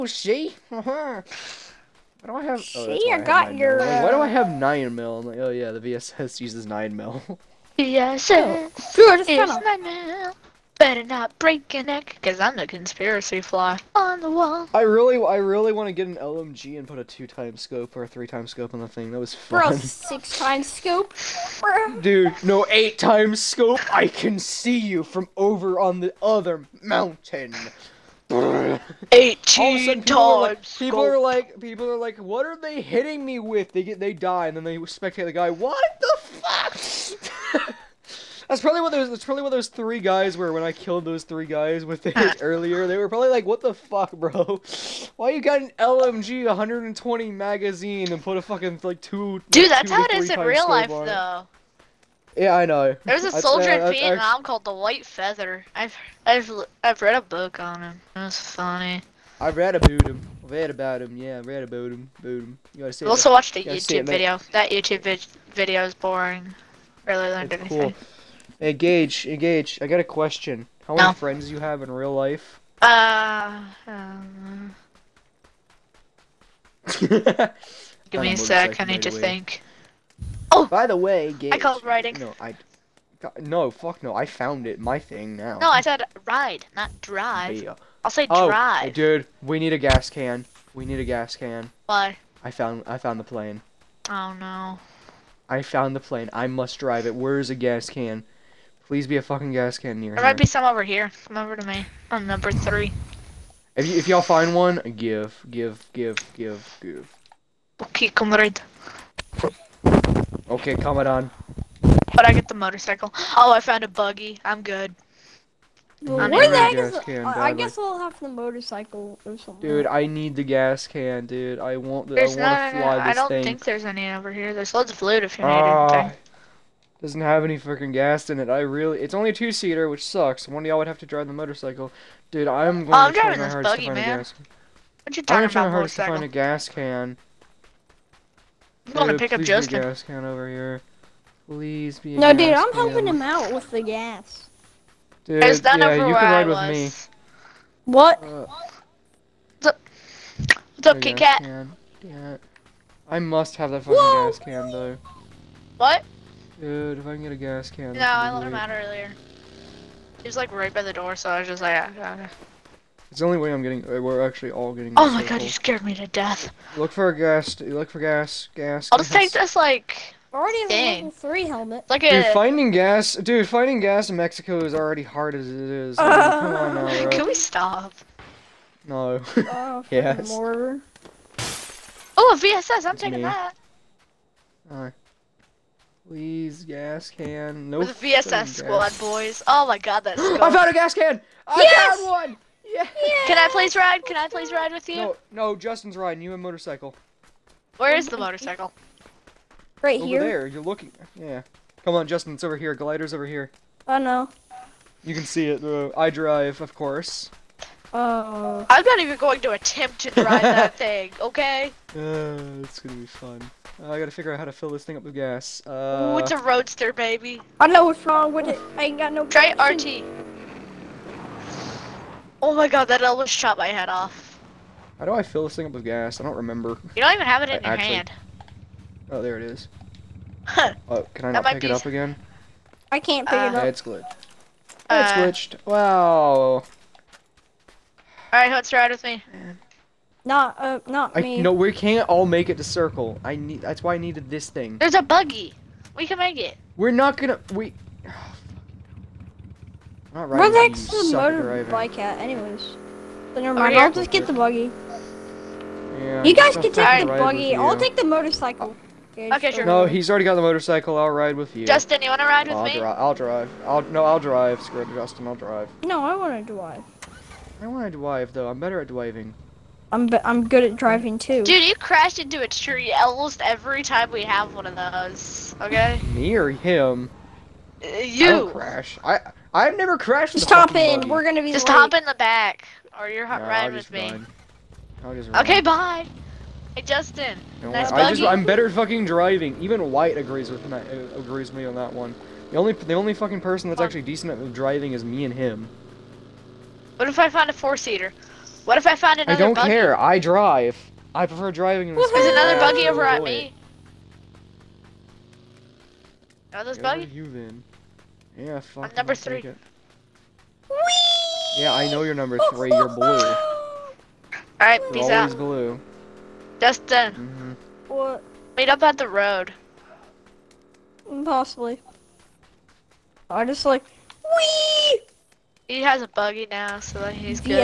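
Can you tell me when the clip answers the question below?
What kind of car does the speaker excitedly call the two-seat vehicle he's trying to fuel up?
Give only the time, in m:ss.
3:36.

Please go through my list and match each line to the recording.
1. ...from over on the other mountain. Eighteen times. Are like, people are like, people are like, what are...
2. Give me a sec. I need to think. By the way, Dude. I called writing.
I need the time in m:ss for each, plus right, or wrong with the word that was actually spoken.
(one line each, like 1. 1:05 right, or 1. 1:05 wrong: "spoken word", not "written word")
1. 0:25 right
2. 1:18 wrong: "Gage", not "Dude".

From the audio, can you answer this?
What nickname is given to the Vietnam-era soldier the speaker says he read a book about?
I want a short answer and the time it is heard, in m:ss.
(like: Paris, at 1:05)
White Feather, at 0:54.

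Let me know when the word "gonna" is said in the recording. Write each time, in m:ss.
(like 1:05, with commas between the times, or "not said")
3:32, 4:07, 4:41.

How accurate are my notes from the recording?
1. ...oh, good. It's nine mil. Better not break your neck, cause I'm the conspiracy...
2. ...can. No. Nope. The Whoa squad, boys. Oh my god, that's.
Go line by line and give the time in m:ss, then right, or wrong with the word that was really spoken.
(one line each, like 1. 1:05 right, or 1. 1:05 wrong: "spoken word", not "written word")
1. 0:08 right
2. 3:07 wrong: "VSS", not "Whoa".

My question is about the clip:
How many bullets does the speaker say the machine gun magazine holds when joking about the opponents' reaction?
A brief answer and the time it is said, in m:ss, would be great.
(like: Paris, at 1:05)
120, at 0:46.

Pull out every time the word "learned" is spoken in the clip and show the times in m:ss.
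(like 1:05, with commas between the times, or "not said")
1:07.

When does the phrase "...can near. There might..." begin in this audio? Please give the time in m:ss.
1:39.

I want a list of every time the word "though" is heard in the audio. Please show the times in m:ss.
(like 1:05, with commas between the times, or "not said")
0:50, 2:34, 4:28.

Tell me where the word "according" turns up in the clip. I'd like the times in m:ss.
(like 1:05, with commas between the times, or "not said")
not said.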